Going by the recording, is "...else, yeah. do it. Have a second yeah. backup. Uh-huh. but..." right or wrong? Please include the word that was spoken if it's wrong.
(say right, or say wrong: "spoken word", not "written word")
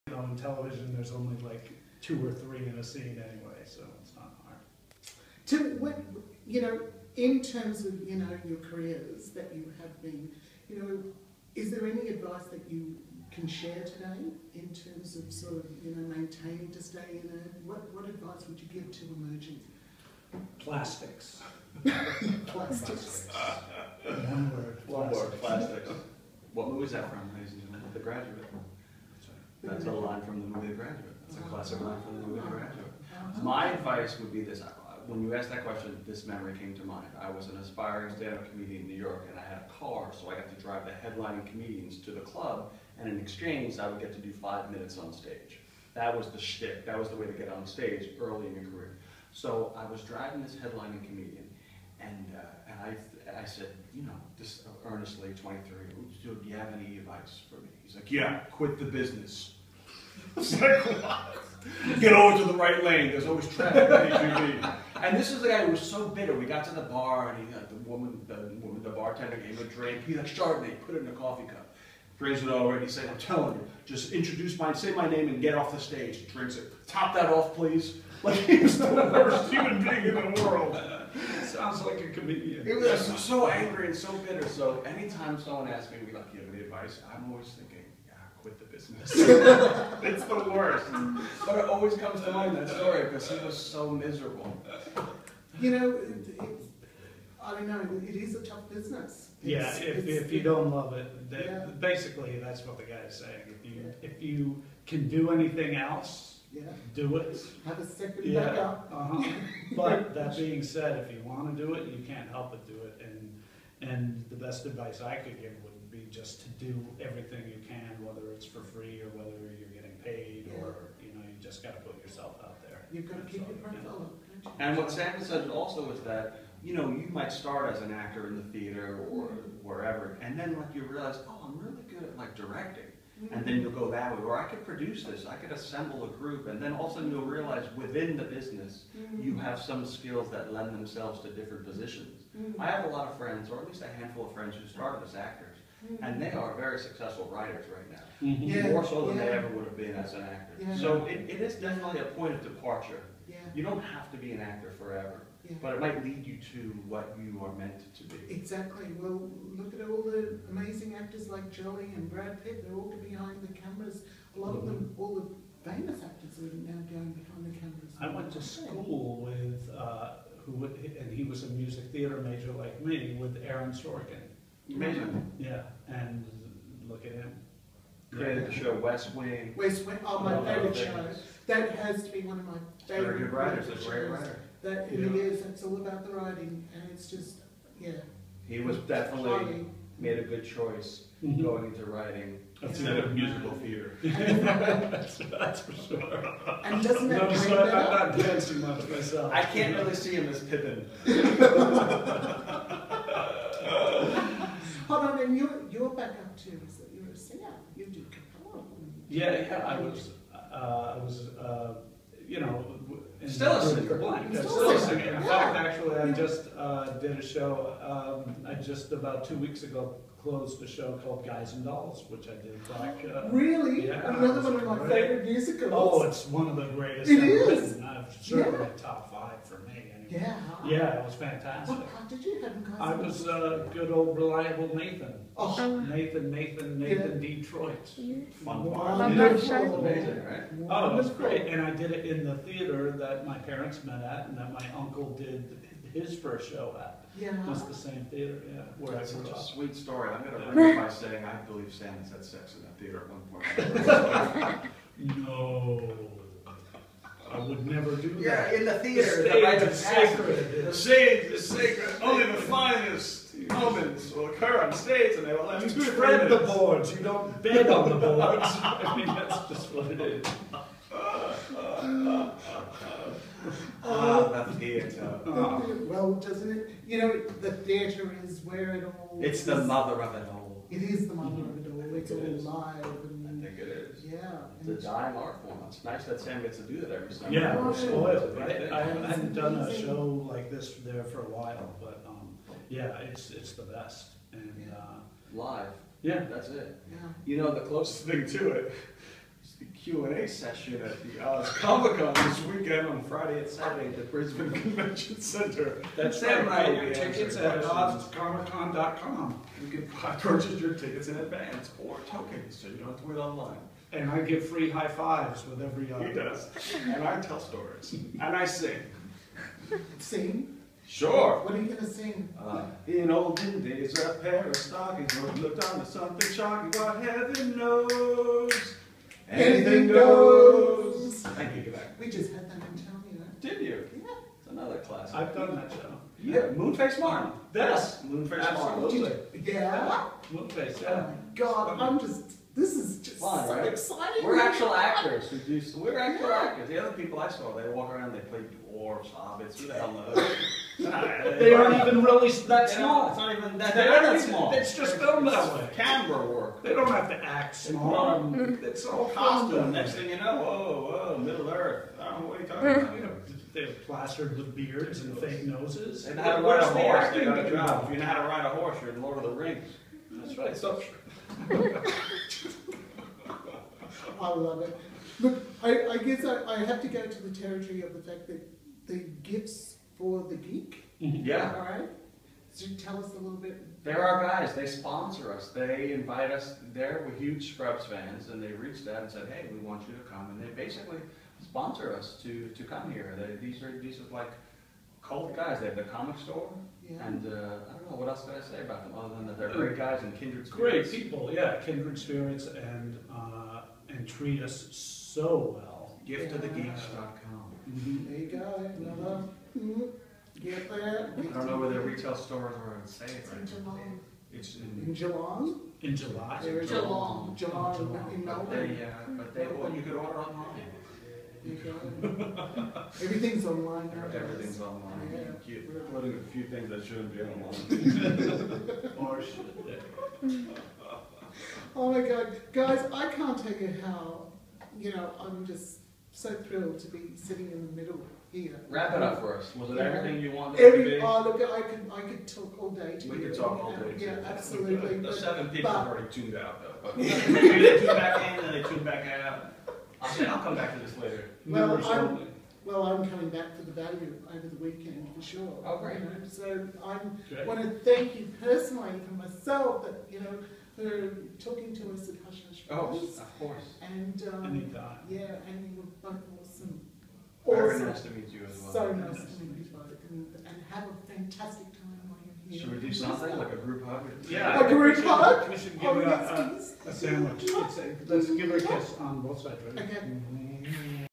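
right.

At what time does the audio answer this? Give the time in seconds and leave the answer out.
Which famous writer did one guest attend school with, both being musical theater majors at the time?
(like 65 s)
173 s.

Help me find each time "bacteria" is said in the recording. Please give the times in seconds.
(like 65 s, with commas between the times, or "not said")
not said.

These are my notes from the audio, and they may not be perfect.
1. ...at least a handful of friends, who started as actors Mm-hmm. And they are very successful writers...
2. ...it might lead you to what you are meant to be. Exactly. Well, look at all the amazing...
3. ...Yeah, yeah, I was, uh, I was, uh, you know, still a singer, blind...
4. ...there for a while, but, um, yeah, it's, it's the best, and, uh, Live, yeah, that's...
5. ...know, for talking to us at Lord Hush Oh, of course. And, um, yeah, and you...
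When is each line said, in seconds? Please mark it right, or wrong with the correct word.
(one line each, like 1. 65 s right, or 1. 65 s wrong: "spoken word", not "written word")
1. 143 s right
2. 155 s right
3. 209 s right
4. 290 s right
5. 460 s wrong: "Hush", not "Lord".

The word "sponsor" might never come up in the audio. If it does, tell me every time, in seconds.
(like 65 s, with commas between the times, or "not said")
384 s, 391 s.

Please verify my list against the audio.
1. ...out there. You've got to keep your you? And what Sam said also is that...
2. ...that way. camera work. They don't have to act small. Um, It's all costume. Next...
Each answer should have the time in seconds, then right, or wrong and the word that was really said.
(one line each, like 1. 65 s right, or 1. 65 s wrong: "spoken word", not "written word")
1. 122 s right
2. 355 s right.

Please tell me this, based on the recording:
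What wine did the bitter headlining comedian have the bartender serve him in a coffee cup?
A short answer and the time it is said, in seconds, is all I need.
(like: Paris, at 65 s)
Chardonnay, at 70 s.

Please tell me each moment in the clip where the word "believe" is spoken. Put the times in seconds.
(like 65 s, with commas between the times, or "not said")
251 s.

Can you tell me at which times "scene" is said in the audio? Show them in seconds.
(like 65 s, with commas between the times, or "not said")
2 s.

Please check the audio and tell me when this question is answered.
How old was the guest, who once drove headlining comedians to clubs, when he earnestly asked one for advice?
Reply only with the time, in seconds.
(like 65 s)
55 s.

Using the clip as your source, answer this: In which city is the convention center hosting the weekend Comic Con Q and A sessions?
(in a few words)
Brisbane.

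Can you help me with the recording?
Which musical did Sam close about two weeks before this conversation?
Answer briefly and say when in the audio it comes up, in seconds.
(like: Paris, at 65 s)
Guys and Dolls, at 221 s.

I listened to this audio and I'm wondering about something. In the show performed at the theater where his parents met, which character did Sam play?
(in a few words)
Nathan Detroit.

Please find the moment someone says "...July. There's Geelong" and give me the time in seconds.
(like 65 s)
415 s.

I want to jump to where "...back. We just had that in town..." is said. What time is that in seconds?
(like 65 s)
331 s.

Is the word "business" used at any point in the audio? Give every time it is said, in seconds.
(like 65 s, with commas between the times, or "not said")
58 s, 88 s, 98 s, 138 s.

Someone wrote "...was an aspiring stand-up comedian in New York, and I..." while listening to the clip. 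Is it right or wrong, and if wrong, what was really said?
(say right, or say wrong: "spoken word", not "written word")
right.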